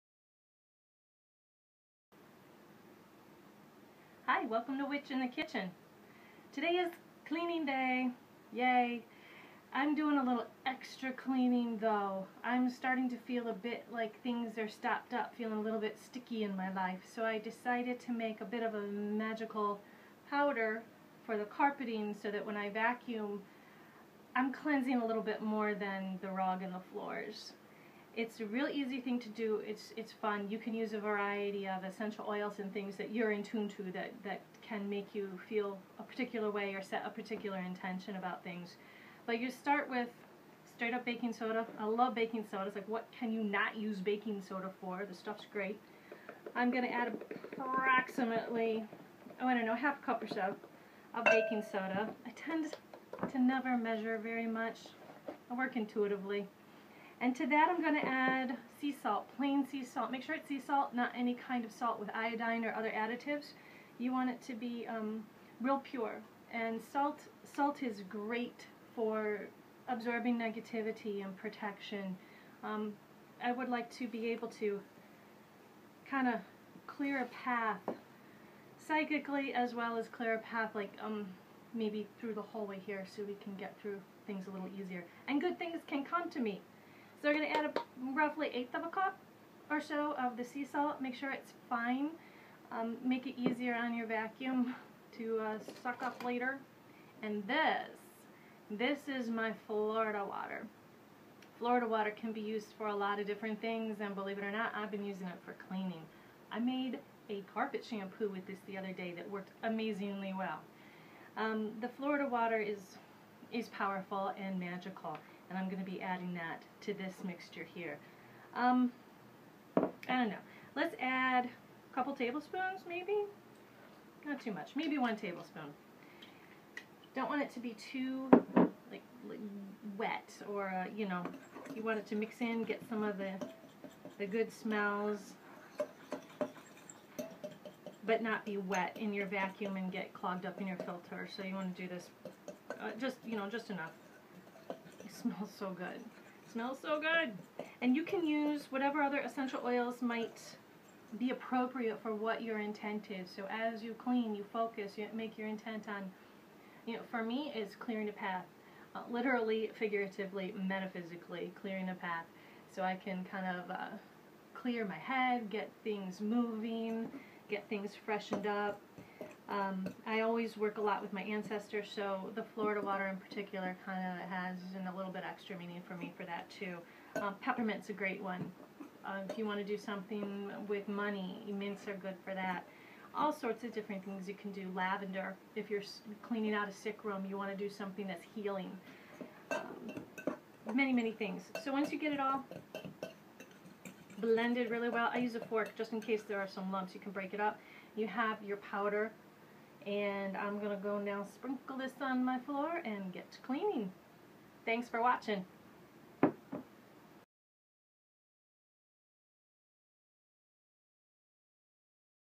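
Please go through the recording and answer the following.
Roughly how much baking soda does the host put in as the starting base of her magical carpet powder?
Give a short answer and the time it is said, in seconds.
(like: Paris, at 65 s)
half cup, at 49 s.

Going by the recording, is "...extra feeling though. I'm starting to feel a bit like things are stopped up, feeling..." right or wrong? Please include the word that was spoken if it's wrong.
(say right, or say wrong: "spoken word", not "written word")
wrong: "cleaning", not "feeling".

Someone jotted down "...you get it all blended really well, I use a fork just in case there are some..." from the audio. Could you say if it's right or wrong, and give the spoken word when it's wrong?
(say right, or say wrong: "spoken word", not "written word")
right.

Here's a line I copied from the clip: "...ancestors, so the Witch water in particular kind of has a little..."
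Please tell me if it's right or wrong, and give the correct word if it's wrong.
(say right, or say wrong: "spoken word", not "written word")
wrong: "Florida", not "Witch".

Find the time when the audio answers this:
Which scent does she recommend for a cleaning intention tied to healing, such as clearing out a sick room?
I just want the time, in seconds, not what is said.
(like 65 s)
184 s.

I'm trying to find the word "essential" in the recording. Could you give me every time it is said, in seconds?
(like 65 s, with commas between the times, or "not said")
31 s, 149 s.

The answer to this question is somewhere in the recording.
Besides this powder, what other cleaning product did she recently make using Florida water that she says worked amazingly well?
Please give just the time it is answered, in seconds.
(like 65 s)
107 s.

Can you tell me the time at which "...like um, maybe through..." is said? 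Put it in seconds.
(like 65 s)
80 s.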